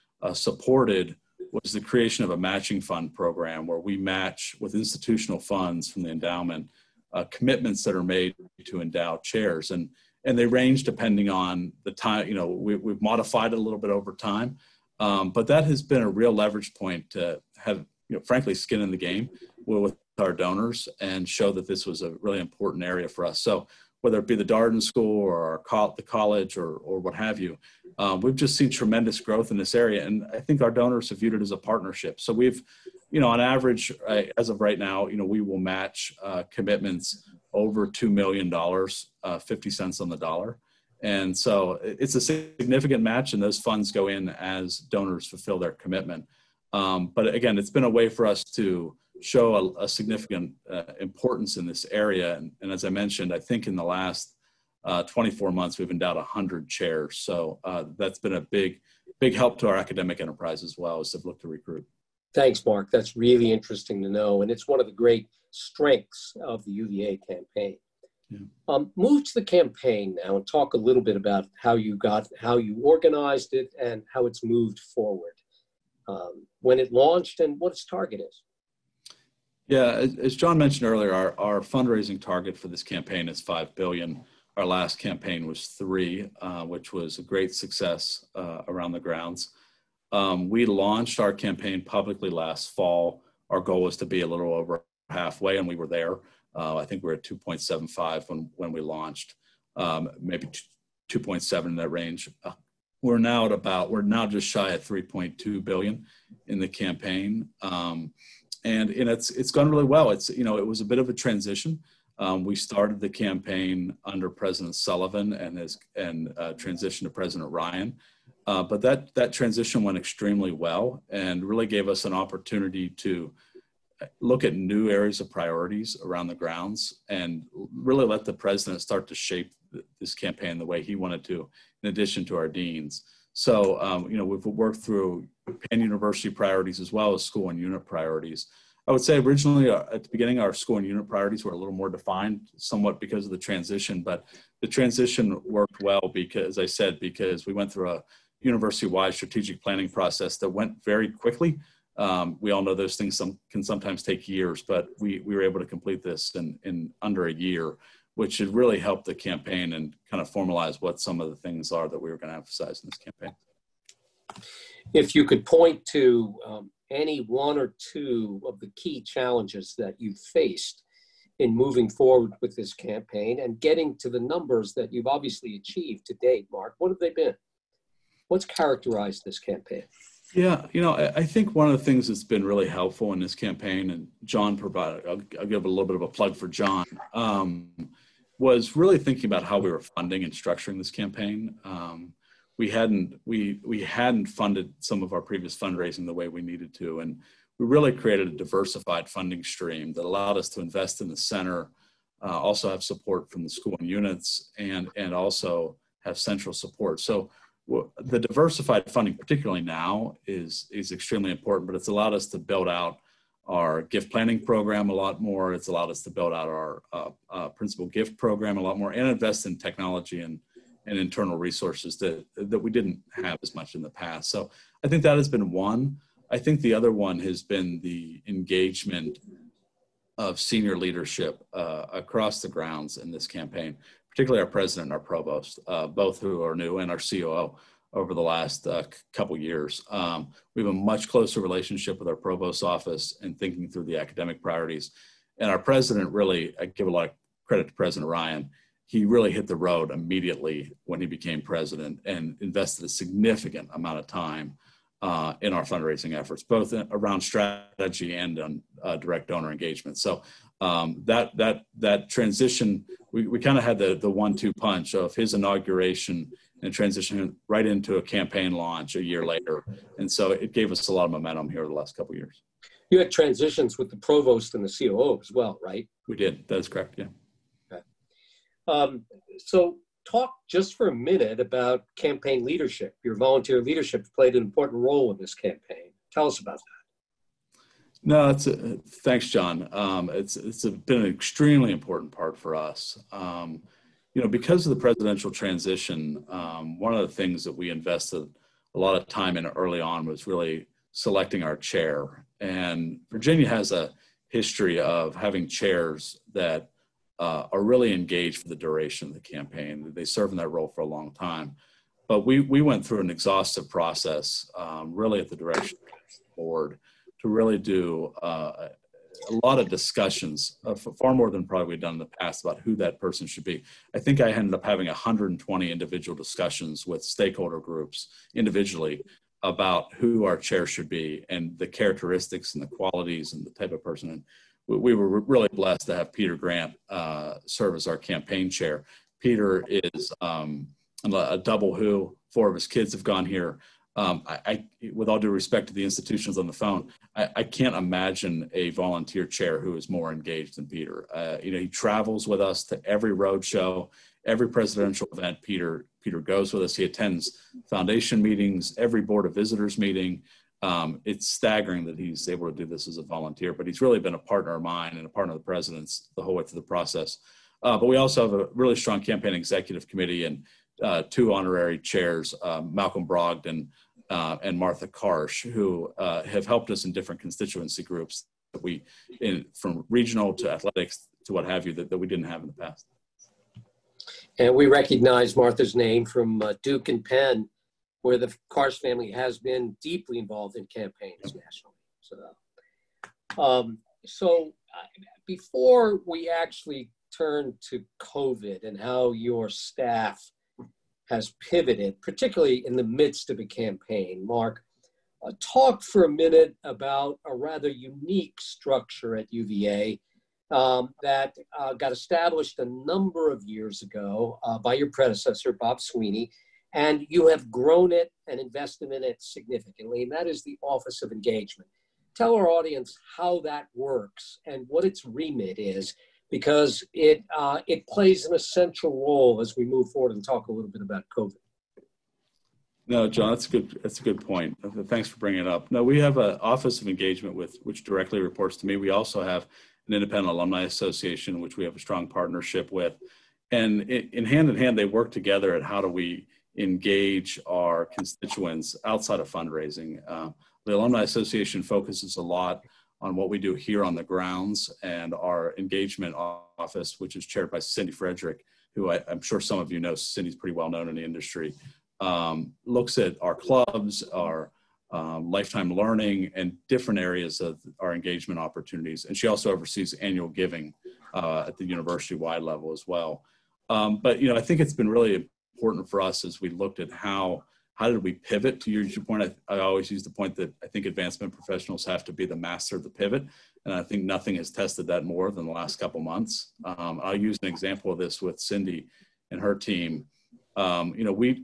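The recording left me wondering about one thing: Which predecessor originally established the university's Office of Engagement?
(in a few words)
Bob Sweeney.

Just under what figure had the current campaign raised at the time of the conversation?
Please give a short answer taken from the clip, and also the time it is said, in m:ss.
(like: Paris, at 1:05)
3.2 billion, at 1:44.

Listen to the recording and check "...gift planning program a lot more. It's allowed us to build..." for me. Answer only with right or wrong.
right.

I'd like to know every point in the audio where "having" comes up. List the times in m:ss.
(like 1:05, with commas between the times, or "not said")
5:05, 5:24.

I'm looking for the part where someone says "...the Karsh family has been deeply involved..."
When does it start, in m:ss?
6:28.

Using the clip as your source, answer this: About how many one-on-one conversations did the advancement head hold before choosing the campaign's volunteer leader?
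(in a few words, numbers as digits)
120.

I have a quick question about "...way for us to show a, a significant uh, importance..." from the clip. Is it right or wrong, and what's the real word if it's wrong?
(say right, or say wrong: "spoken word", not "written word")
right.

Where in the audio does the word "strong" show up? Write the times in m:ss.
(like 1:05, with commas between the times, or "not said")
6:08, 7:21.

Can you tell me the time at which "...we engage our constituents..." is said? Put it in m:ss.
7:25.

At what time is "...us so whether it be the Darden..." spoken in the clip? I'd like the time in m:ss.
0:23.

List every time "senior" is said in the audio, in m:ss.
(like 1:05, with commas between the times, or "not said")
3:50.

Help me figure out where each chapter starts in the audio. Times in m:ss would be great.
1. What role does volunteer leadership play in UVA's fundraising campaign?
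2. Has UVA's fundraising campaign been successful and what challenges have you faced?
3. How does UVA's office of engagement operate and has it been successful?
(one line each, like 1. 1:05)
1. 4:46
2. 1:15
3. 7:11.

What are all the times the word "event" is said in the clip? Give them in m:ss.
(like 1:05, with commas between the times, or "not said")
5:55.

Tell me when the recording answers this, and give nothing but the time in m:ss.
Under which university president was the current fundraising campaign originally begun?
1:54.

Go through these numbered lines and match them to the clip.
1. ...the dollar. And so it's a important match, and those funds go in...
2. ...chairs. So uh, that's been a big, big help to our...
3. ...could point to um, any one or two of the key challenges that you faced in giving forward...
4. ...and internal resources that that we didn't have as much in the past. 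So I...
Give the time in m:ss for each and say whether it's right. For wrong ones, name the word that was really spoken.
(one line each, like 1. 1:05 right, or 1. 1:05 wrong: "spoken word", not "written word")
1. 0:40 wrong: "significant", not "important"
2. 0:56 right
3. 2:45 wrong: "moving", not "giving"
4. 3:40 right.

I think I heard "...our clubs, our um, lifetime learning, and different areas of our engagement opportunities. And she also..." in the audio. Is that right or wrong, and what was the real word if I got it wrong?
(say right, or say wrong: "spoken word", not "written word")
right.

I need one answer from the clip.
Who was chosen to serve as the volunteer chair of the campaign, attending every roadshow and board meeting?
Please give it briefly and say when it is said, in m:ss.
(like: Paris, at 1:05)
Peter Grant, at 5:36.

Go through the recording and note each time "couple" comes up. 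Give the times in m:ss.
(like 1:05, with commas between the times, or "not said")
3:59, 4:31, 8:05.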